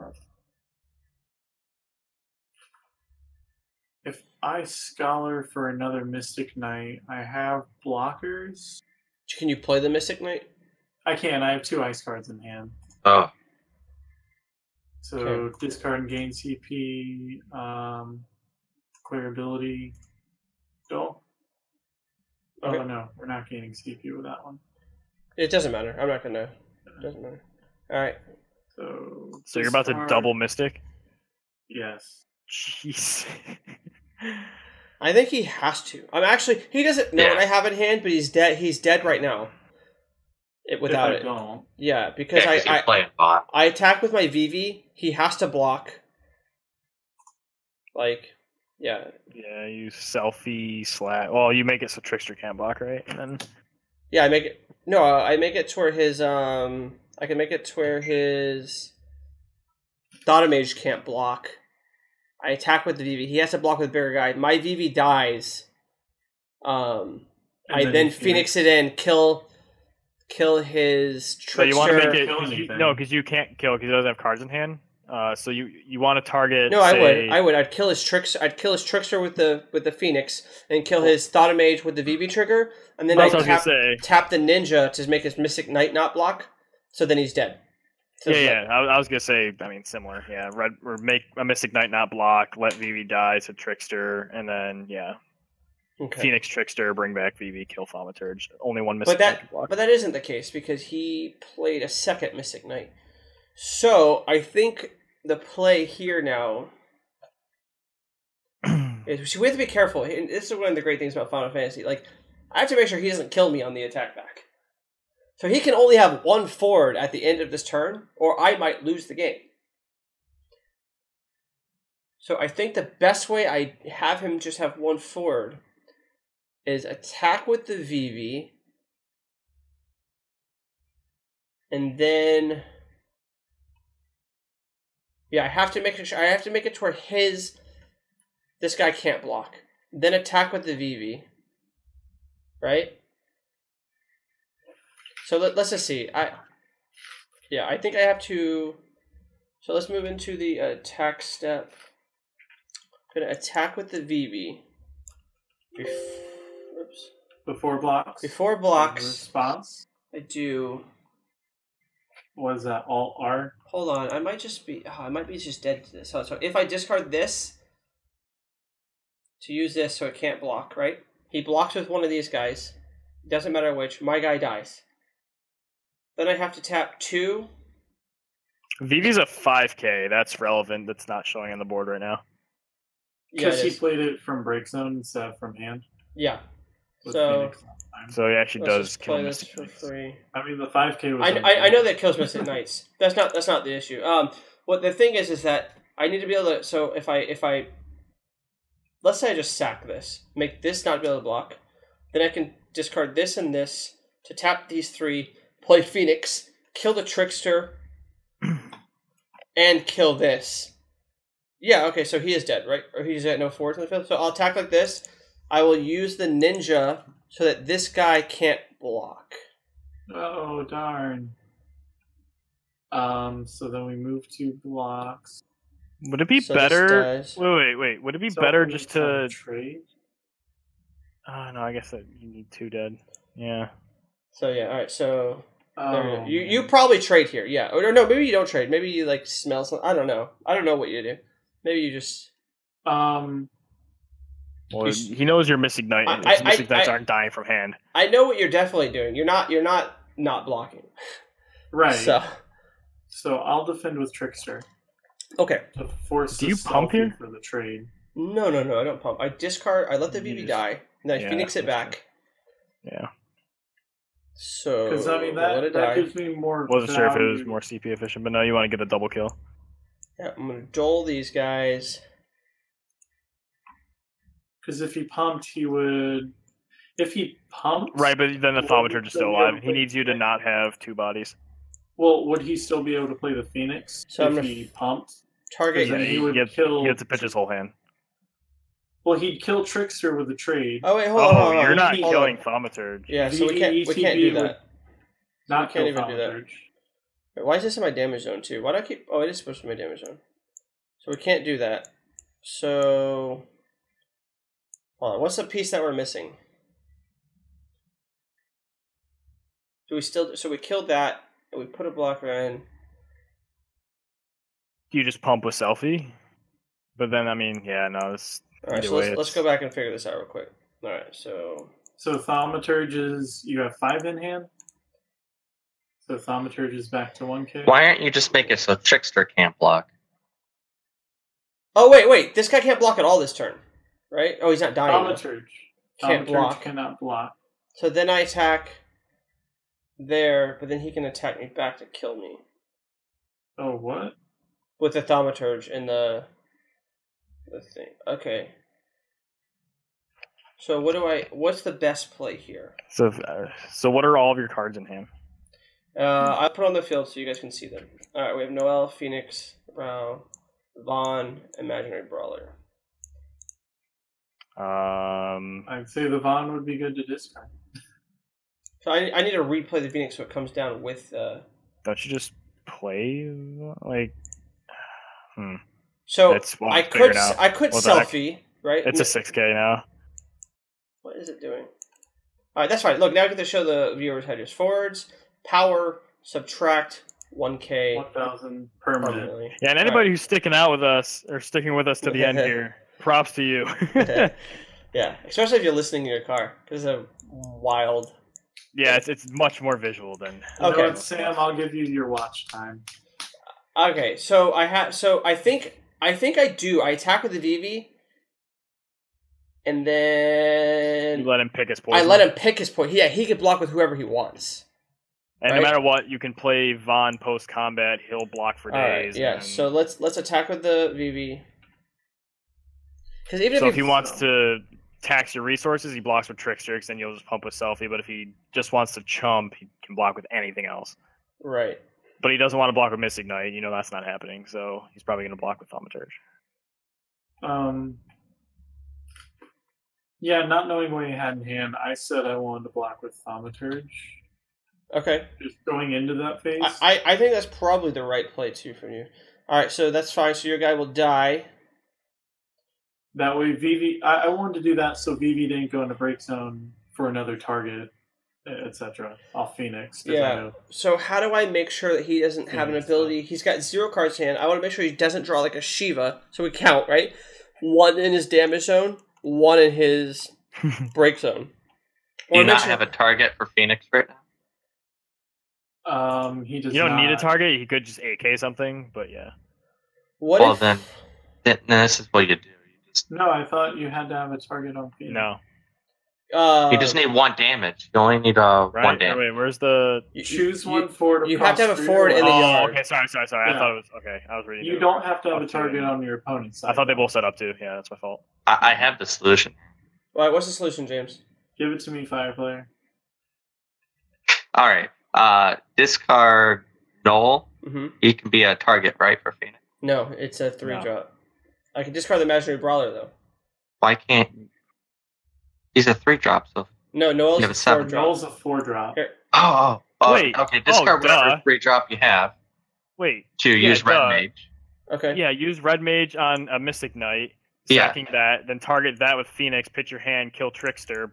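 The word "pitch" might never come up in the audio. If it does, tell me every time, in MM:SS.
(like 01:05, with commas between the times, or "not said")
04:47, 08:49.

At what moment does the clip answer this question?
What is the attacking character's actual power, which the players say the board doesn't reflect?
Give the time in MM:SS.
02:58.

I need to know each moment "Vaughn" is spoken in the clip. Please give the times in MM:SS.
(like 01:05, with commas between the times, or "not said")
06:00, 06:06.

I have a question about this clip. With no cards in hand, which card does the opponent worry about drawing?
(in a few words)
Shiva.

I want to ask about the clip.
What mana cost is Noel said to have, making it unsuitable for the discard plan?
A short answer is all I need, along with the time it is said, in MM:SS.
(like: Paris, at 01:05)
4, at 08:38.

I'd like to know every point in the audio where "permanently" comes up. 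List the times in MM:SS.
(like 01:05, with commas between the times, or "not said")
06:28.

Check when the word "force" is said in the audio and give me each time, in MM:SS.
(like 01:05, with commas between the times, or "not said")
03:33, 04:16.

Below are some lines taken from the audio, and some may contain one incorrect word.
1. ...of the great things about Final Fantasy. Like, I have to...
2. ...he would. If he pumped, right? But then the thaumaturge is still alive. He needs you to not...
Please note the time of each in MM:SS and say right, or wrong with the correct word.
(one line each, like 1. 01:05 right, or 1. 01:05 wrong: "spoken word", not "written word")
1. 01:50 right
2. 04:35 right.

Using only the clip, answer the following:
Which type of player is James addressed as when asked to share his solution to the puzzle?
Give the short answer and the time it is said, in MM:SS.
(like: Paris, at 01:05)
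fire player, at 08:22.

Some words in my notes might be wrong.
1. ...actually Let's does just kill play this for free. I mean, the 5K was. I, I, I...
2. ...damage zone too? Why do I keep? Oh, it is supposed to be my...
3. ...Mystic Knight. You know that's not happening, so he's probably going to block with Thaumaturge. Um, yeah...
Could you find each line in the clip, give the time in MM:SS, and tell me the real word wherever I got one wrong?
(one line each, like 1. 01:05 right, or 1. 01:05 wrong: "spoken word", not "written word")
1. 03:08 right
2. 04:57 right
3. 07:12 right.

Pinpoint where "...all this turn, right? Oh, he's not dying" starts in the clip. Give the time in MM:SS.
05:33.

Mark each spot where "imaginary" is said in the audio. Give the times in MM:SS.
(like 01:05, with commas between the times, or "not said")
06:01, 08:32.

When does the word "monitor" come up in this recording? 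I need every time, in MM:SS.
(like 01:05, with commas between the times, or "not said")
not said.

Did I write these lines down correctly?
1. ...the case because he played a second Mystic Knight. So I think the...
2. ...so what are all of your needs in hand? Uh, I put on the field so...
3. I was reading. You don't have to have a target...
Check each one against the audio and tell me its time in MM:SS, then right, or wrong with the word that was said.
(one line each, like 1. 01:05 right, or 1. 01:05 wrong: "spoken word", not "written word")
1. 01:40 right
2. 05:53 wrong: "cards", not "needs"
3. 08:14 right.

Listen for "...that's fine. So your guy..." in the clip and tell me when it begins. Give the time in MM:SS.
07:29.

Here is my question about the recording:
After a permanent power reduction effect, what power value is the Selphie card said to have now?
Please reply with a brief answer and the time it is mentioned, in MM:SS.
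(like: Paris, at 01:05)
6K, at 06:18.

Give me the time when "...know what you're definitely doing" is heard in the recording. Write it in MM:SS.
04:08.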